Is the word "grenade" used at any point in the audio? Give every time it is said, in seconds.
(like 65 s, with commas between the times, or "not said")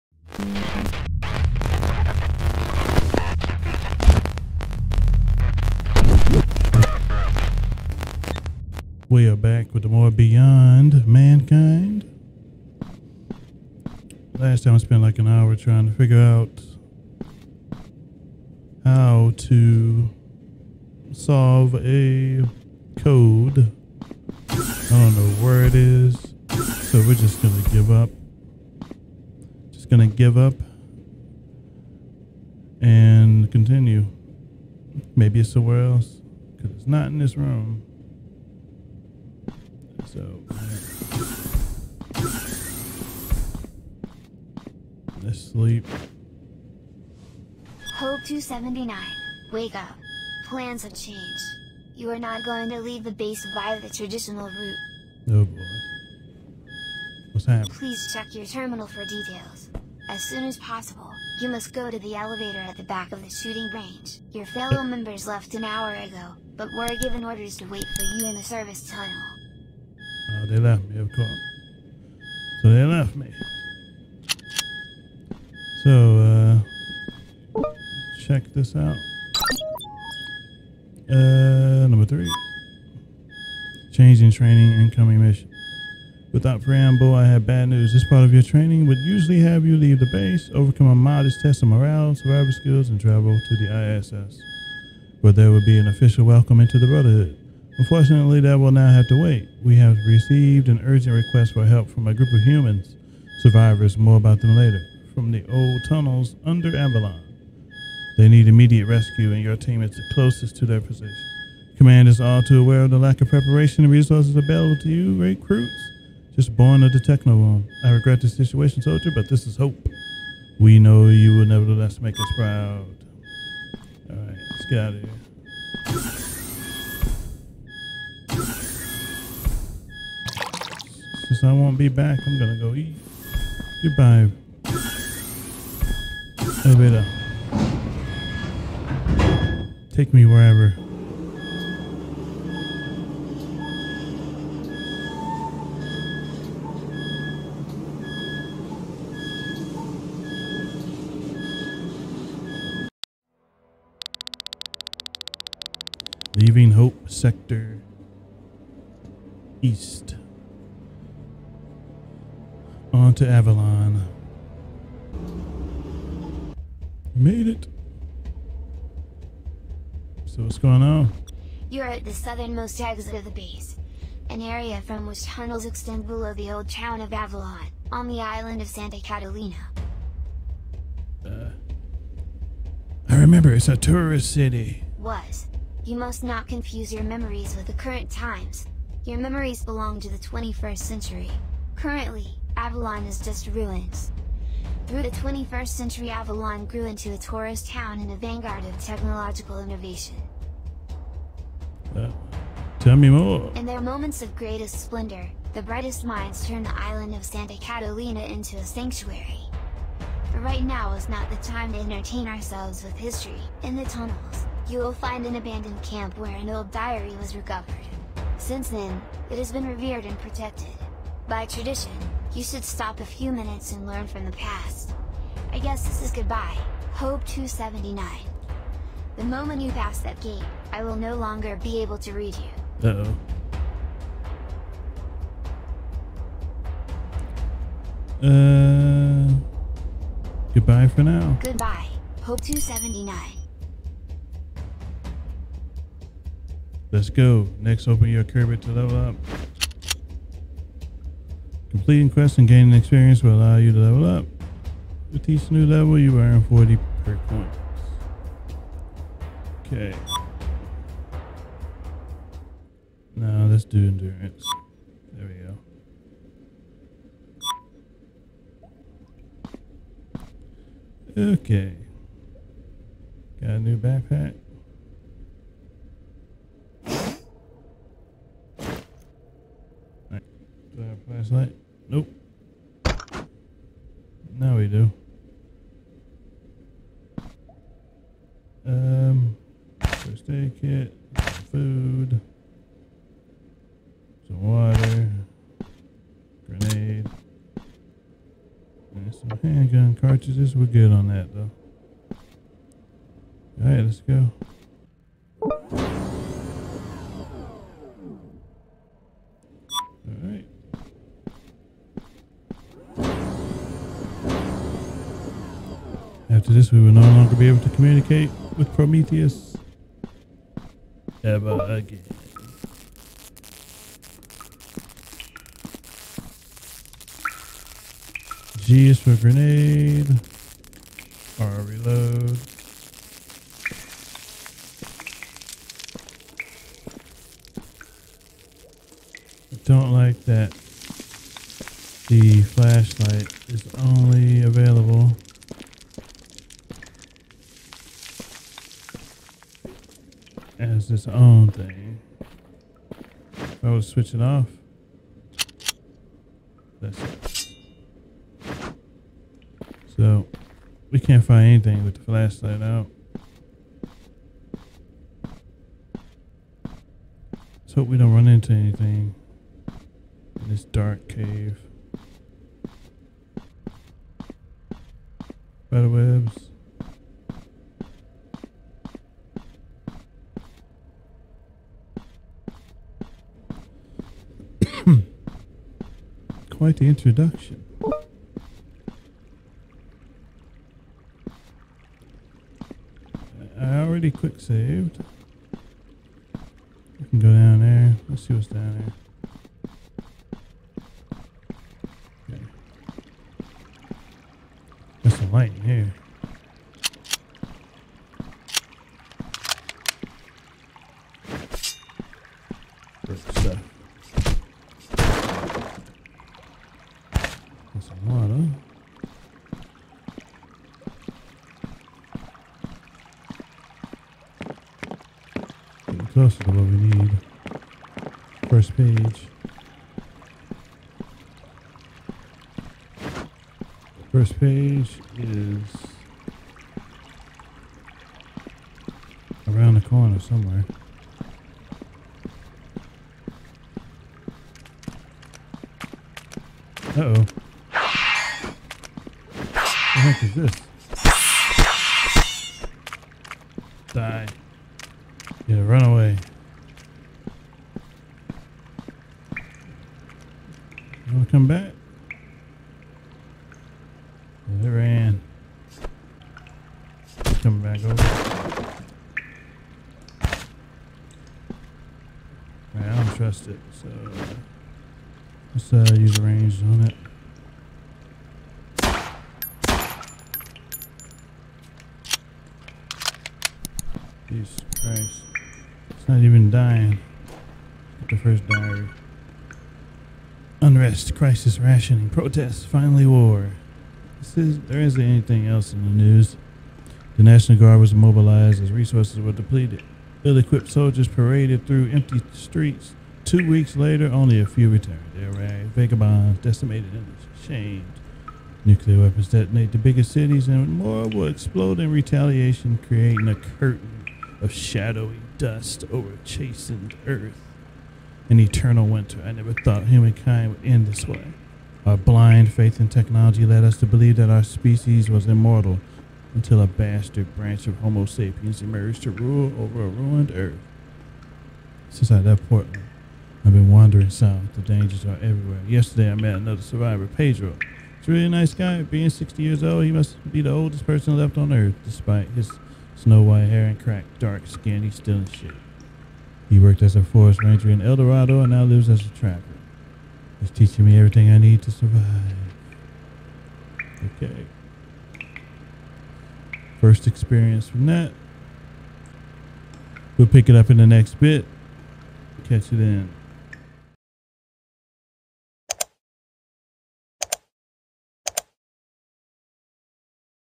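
296 s, 329 s.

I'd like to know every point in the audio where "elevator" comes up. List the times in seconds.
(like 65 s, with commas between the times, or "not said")
62 s, 136 s.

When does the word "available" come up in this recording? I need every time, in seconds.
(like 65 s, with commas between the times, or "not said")
114 s, 344 s.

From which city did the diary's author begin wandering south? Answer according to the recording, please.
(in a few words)
Portland.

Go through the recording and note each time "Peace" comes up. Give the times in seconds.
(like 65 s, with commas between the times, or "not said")
484 s.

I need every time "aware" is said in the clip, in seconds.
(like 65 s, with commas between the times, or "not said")
112 s.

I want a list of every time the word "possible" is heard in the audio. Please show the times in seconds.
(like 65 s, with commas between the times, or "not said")
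60 s.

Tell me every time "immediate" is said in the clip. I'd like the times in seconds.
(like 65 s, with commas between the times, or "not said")
108 s.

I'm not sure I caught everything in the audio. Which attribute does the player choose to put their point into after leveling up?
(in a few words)
Endurance.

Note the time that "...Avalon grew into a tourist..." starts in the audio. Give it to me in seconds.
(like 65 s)
196 s.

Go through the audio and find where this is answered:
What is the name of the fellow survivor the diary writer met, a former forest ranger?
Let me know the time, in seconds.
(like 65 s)
537 s.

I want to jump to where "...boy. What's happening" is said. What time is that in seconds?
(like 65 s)
55 s.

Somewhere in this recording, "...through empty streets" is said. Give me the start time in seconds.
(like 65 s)
501 s.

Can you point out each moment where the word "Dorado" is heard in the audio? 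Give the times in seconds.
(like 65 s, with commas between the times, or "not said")
547 s.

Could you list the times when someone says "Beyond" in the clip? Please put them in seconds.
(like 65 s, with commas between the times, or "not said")
10 s.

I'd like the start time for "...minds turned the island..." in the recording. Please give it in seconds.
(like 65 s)
206 s.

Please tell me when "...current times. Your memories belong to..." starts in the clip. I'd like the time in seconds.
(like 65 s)
187 s.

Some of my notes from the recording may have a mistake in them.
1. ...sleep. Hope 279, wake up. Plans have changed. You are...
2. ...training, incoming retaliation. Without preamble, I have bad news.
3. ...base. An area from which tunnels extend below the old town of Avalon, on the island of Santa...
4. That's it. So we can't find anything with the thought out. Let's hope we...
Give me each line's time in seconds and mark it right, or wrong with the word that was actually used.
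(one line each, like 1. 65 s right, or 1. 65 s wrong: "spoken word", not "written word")
1. 45 s right
2. 84 s wrong: "mission", not "retaliation"
3. 173 s right
4. 356 s wrong: "flashlight", not "thought".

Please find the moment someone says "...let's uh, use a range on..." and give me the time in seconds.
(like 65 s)
475 s.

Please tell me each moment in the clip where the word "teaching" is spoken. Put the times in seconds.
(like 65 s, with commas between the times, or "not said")
550 s.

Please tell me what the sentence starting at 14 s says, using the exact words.
Last time I spent like an hour trying to figure out how to solve a code.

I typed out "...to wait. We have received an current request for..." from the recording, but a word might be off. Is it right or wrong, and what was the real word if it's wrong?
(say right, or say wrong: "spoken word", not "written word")
wrong: "urgent", not "current".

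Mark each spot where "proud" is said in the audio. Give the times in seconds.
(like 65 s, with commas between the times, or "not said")
122 s.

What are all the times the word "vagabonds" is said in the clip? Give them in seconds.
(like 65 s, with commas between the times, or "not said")
505 s.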